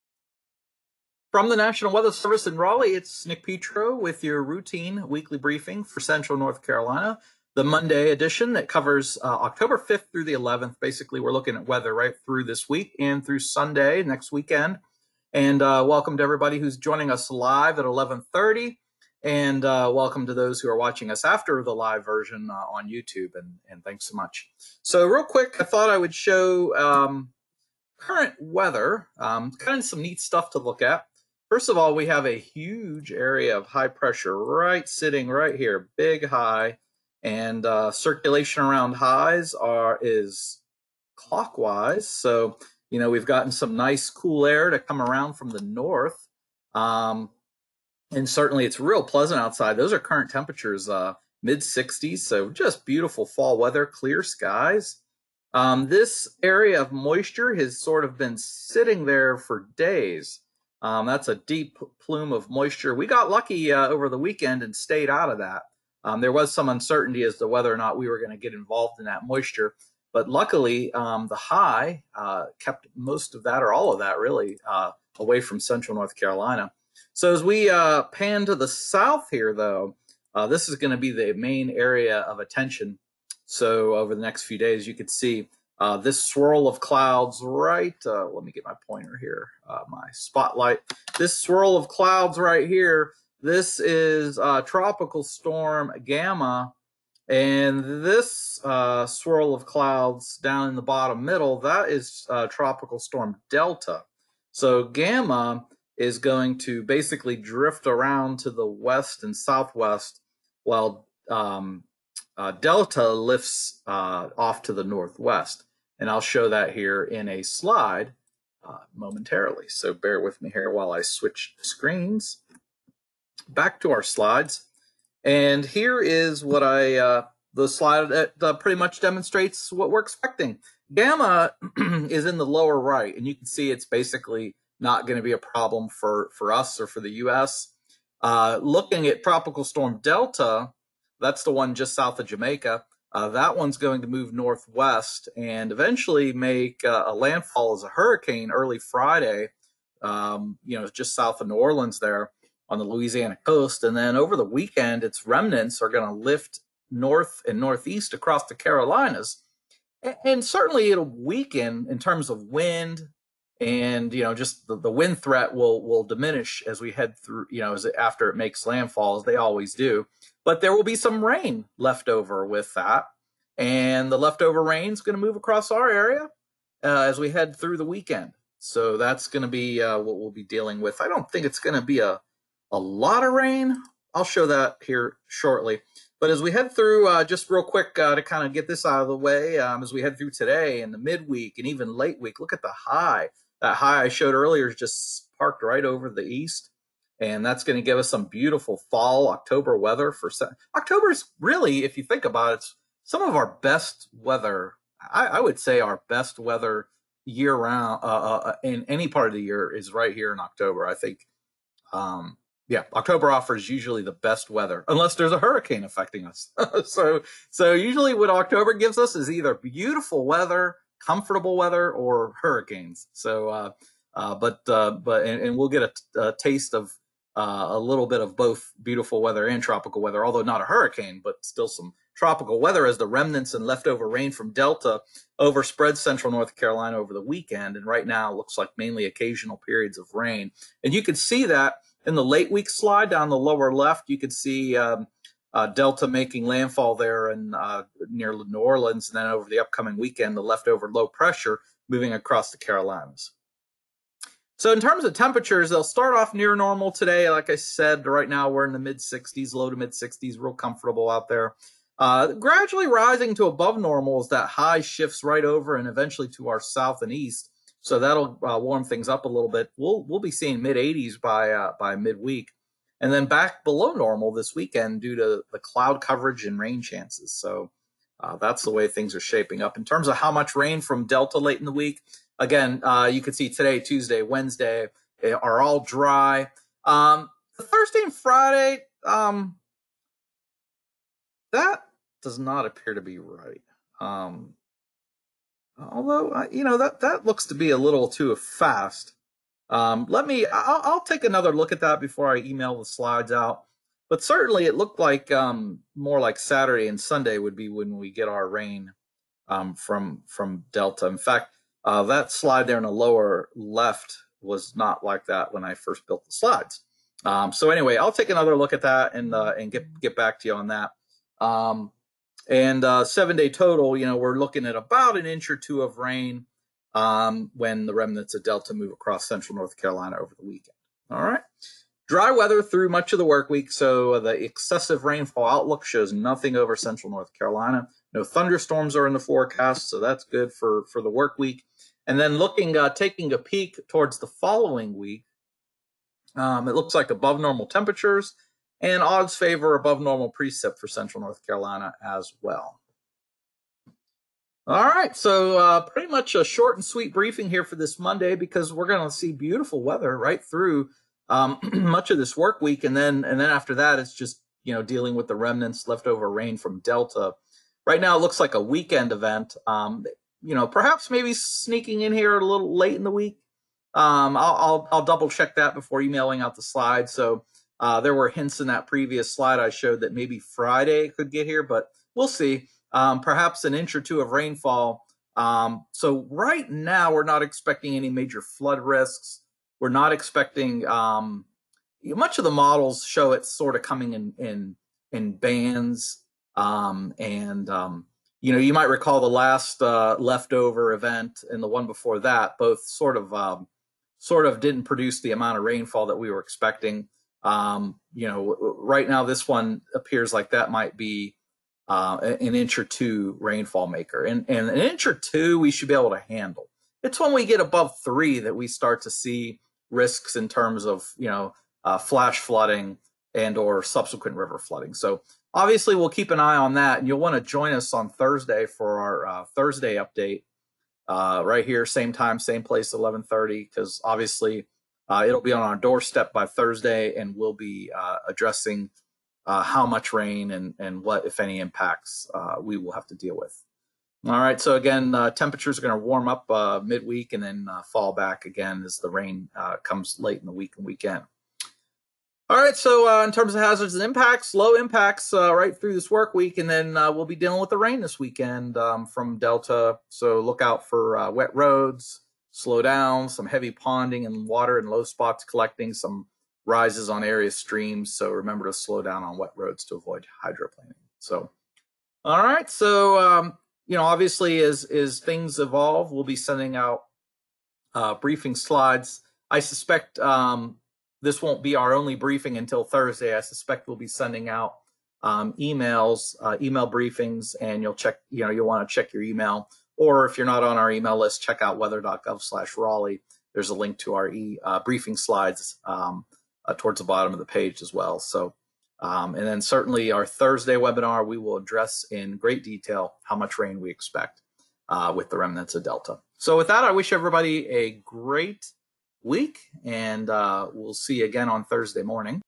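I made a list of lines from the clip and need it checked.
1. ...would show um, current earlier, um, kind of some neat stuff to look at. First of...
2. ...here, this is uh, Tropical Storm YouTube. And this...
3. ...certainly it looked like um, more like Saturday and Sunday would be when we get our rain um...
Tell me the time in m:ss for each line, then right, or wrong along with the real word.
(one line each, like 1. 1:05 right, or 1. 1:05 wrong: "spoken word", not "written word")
1. 0:25 wrong: "weather", not "earlier"
2. 1:32 wrong: "Gamma", not "YouTube"
3. 5:04 right.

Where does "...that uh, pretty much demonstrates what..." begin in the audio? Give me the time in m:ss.
2:08.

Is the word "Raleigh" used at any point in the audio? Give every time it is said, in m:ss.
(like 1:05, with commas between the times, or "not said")
0:02, 8:12.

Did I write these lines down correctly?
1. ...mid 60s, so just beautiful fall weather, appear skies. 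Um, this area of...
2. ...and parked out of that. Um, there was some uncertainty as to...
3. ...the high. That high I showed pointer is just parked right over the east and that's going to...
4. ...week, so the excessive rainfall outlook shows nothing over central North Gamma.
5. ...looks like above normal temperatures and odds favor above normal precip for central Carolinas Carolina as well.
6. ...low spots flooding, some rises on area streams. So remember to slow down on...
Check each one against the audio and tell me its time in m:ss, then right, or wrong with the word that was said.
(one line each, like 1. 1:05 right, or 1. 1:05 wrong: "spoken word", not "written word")
1. 0:51 wrong: "clear", not "appear"
2. 1:04 wrong: "stayed", not "parked"
3. 3:12 wrong: "earlier", not "pointer"
4. 5:33 wrong: "Carolina", not "Gamma"
5. 5:46 wrong: "North", not "Carolinas"
6. 7:44 wrong: "collecting", not "flooding".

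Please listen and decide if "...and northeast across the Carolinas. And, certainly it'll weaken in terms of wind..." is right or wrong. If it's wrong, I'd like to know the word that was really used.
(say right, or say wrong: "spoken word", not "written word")
right.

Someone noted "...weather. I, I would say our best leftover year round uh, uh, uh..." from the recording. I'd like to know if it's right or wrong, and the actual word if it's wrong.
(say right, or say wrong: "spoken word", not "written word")
wrong: "weather", not "leftover".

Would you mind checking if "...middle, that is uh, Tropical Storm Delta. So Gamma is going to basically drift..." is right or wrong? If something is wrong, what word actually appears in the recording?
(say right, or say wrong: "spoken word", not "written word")
right.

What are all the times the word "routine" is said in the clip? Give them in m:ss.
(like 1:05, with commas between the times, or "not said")
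0:04.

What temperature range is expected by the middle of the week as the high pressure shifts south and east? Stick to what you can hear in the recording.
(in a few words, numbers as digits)
mid 80s.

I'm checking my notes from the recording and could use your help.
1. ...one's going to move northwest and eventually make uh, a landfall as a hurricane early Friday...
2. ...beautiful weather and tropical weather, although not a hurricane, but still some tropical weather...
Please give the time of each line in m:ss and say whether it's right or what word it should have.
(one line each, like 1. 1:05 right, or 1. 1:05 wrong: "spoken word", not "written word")
1. 2:23 right
2. 3:48 right.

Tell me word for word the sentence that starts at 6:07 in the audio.
Right now, it looks like a weekend event.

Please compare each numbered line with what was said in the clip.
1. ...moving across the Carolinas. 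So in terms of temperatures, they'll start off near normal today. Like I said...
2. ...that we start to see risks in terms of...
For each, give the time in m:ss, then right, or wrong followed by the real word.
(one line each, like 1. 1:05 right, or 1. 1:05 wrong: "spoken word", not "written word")
1. 4:11 right
2. 6:58 right.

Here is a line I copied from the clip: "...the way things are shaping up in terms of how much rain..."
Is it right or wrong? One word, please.
right.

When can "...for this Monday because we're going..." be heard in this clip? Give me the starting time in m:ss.
5:57.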